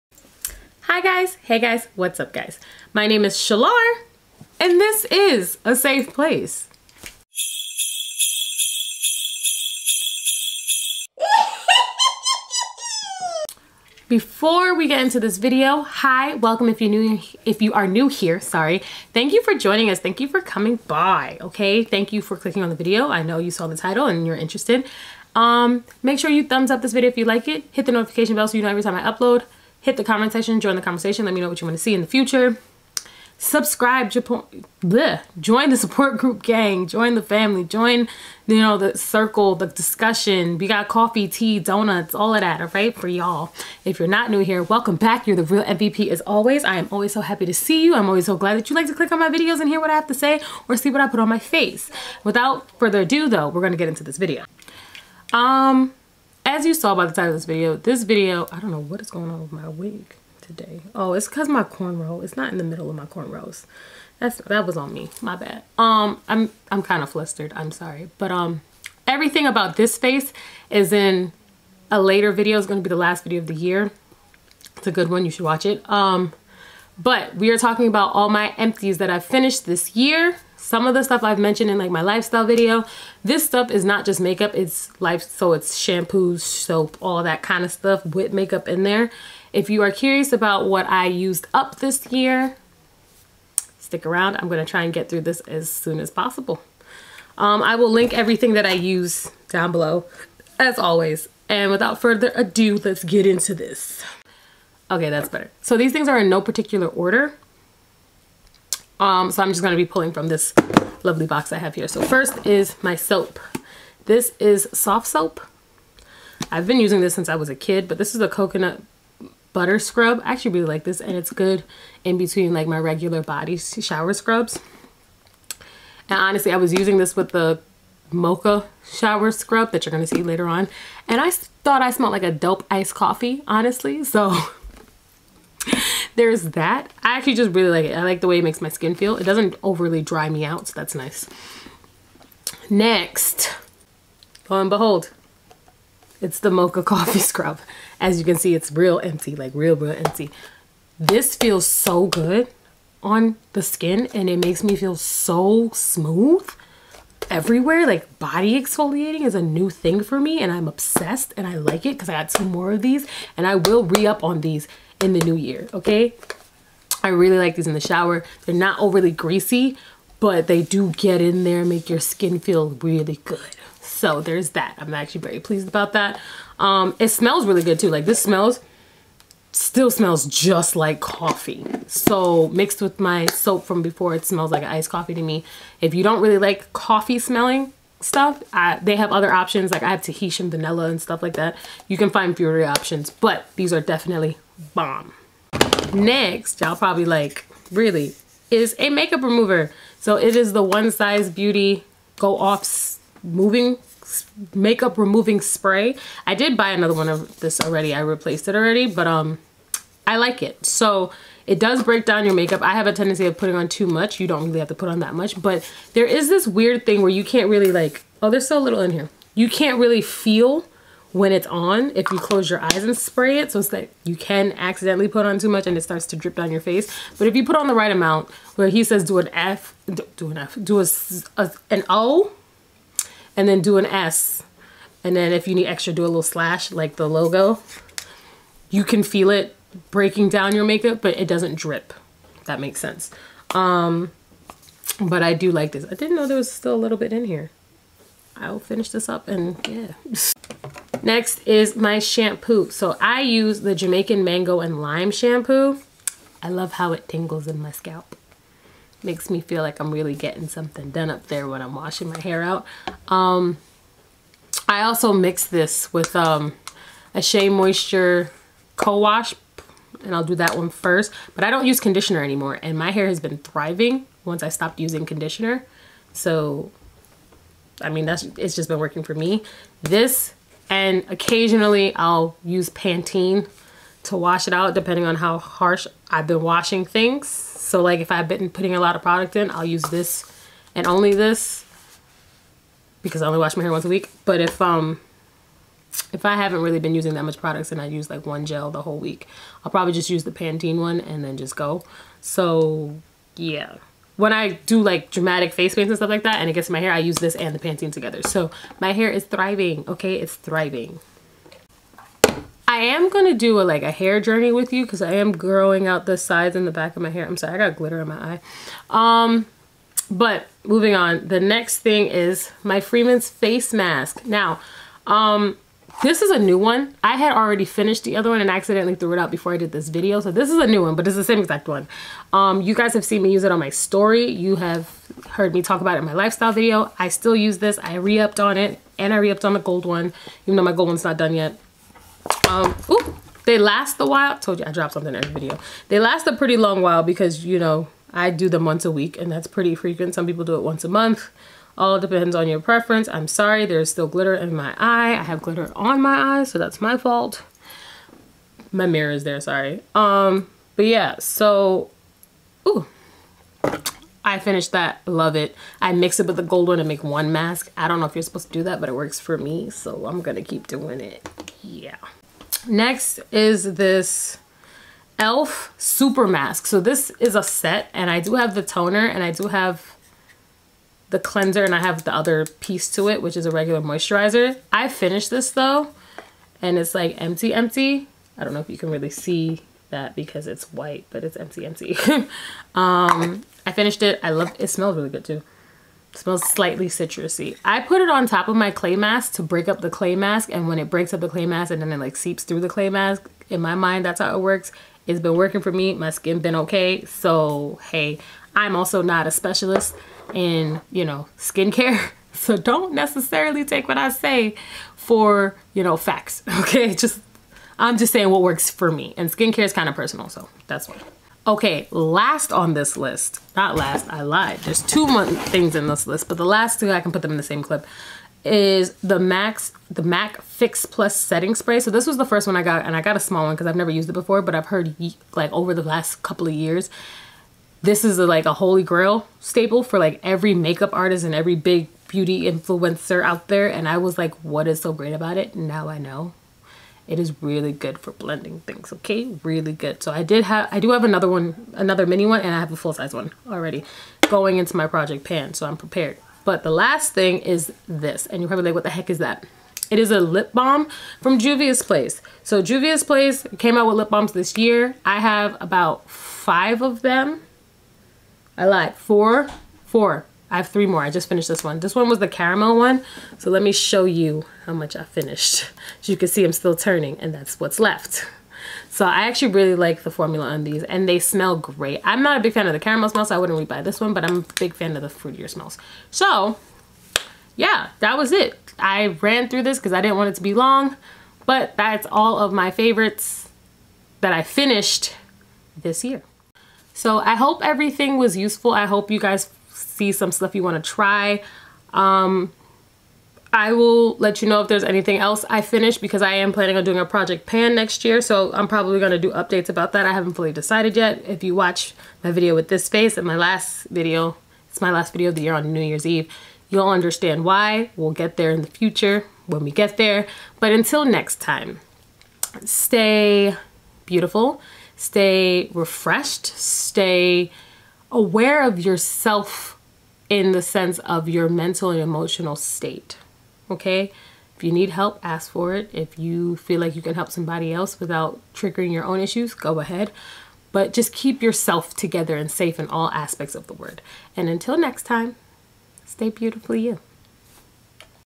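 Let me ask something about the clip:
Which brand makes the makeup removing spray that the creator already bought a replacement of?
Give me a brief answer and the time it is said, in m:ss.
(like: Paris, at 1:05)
One Size Beauty, at 3:20.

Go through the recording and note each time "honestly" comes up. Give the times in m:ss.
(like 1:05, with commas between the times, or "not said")
2:06, 2:13.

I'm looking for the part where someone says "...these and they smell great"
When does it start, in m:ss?
8:00.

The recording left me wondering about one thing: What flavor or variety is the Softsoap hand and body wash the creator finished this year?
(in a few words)
Coconut butter scrub.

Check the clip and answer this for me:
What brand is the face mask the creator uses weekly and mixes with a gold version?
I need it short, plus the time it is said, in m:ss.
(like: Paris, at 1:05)
Freeman's, at 5:22.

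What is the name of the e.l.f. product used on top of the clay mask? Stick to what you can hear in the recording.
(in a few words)
Super Mask.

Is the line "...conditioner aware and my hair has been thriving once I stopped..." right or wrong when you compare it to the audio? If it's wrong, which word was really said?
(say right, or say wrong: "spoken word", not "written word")
wrong: "anymore", not "aware".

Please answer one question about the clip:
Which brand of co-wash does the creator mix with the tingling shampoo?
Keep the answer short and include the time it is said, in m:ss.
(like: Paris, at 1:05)
Shea Moisture, at 4:27.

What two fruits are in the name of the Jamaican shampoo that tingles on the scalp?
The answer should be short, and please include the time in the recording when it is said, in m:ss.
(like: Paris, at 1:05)
Mango and Lime, at 4:14.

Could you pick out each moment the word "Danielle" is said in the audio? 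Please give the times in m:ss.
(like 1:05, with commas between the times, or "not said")
not said.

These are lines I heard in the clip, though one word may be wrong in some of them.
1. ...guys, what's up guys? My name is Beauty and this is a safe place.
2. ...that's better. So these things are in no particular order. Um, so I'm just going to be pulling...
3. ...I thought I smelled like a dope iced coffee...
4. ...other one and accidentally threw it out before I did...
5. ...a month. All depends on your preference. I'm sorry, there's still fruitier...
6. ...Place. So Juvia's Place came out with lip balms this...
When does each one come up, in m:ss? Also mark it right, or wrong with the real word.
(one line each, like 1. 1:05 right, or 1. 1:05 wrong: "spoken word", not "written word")
1. 0:01 wrong: "Chalar", not "Beauty"
2. 1:45 right
3. 2:11 right
4. 5:28 right
5. 5:50 wrong: "glitter", not "fruitier"
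6. 7:41 right.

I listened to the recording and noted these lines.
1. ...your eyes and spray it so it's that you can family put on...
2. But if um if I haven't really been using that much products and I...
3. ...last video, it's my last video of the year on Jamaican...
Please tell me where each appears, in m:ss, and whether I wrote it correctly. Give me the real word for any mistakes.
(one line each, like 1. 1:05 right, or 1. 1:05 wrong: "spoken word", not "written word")
1. 3:42 wrong: "accidentally", not "family"
2. 4:54 right
3. 8:33 wrong: "New", not "Jamaican".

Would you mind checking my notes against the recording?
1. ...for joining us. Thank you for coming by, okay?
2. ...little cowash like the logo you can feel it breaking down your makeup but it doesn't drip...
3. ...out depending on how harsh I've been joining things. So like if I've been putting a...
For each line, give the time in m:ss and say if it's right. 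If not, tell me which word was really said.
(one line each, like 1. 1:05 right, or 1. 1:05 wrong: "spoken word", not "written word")
1. 0:19 right
2. 3:56 wrong: "slash", not "cowash"
3. 4:44 wrong: "washing", not "joining".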